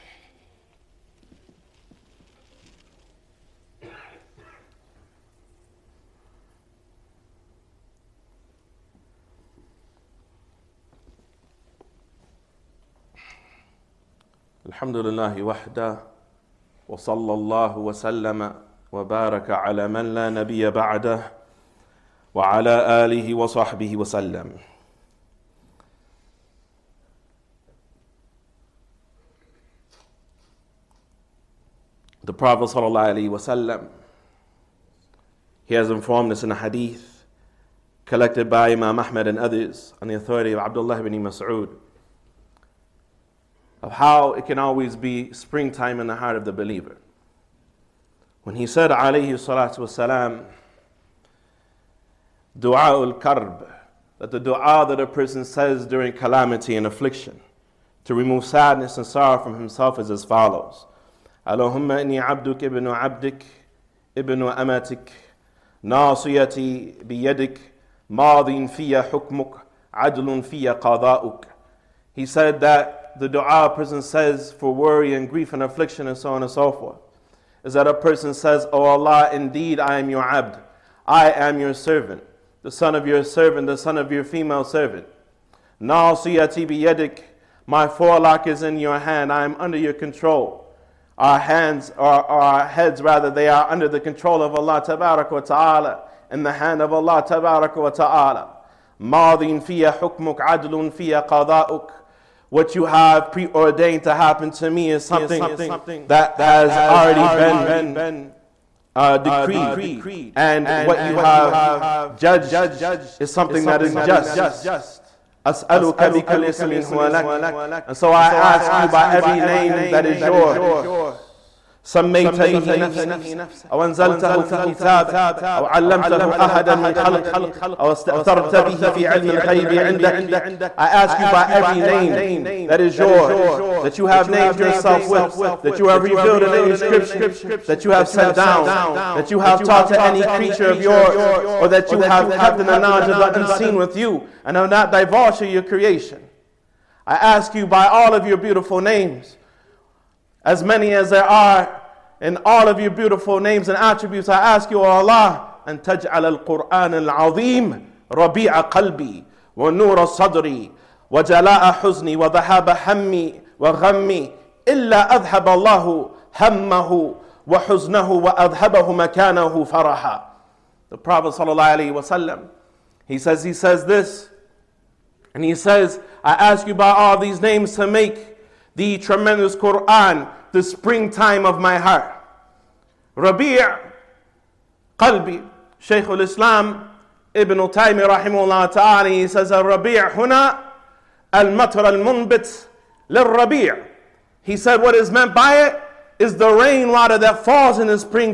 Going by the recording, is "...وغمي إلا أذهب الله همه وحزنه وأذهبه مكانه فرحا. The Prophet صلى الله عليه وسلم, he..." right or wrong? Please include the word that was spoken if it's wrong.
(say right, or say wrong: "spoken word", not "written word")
right.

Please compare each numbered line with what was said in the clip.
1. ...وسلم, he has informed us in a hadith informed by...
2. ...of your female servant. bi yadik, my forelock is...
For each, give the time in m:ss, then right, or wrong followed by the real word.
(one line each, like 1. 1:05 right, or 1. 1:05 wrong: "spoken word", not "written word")
1. 0:32 wrong: "collected", not "informed"
2. 1:23 right.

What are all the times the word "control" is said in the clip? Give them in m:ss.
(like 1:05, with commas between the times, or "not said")
1:29, 1:34.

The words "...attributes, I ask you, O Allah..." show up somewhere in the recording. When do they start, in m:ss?
2:33.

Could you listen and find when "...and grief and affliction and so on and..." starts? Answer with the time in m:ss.
1:15.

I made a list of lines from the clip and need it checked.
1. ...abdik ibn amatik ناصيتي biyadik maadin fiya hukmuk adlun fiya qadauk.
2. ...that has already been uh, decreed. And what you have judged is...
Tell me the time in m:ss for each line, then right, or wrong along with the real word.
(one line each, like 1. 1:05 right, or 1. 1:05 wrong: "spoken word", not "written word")
1. 1:02 right
2. 1:46 right.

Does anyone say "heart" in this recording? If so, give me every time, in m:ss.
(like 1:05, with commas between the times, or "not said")
0:46, 3:01.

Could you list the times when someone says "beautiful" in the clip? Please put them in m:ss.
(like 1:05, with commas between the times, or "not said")
2:28, 2:32.